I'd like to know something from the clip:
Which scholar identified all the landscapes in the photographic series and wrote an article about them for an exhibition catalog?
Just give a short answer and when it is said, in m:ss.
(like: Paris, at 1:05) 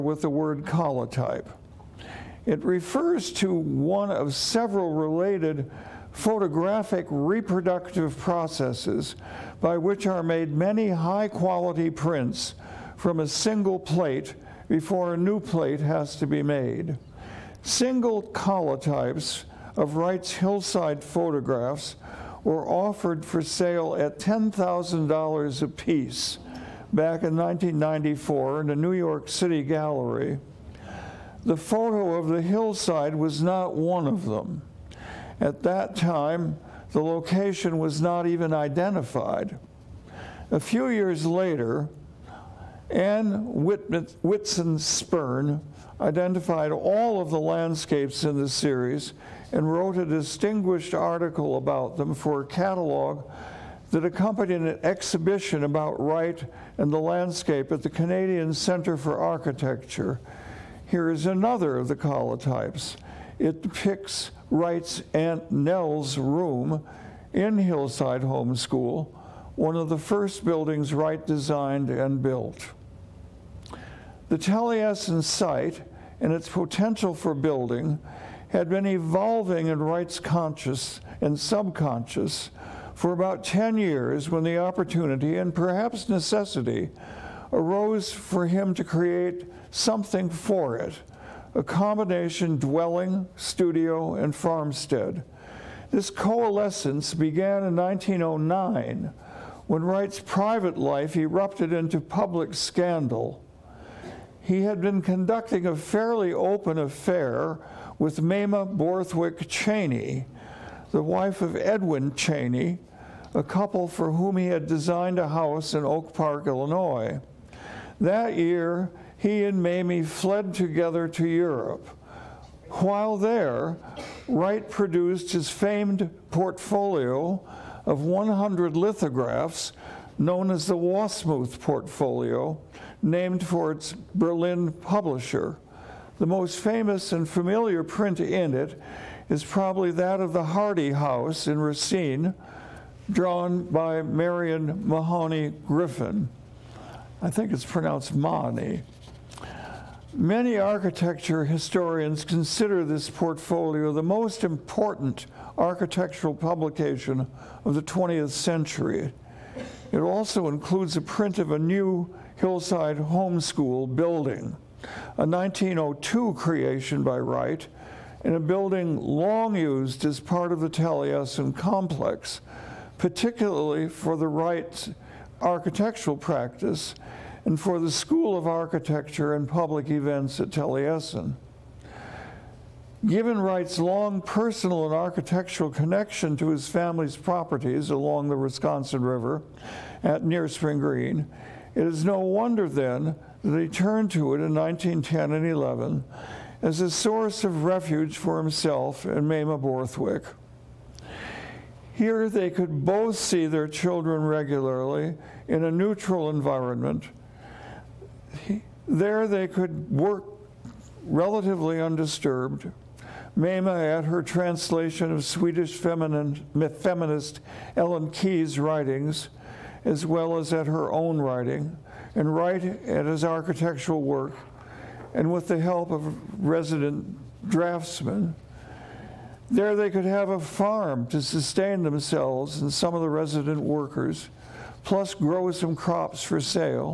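Anne Whiston Spirn, at 0:42.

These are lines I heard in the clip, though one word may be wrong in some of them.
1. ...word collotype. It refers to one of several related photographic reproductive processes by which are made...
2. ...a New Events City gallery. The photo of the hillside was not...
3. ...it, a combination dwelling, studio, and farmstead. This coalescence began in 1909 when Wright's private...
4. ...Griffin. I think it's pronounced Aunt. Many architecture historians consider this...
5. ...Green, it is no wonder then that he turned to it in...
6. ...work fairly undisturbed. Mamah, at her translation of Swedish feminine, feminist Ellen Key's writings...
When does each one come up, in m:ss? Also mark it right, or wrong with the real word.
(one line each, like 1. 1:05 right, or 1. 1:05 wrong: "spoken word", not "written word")
1. 0:00 right
2. 0:28 wrong: "York", not "Events"
3. 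1:30 right
4. 2:25 wrong: "Mahoney", not "Aunt"
5. 3:10 right
6. 3:29 wrong: "relatively", not "fairly".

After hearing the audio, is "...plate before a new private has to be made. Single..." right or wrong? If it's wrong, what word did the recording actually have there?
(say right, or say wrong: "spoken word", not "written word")
wrong: "plate", not "private".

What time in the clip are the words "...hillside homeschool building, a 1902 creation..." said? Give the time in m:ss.
2:42.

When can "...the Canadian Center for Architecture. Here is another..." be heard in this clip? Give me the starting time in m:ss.
0:57.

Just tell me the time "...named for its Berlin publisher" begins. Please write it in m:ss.
2:13.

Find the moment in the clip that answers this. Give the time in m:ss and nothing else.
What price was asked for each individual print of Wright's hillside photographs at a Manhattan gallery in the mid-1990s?
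0:24.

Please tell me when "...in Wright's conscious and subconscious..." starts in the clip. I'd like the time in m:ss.
1:19.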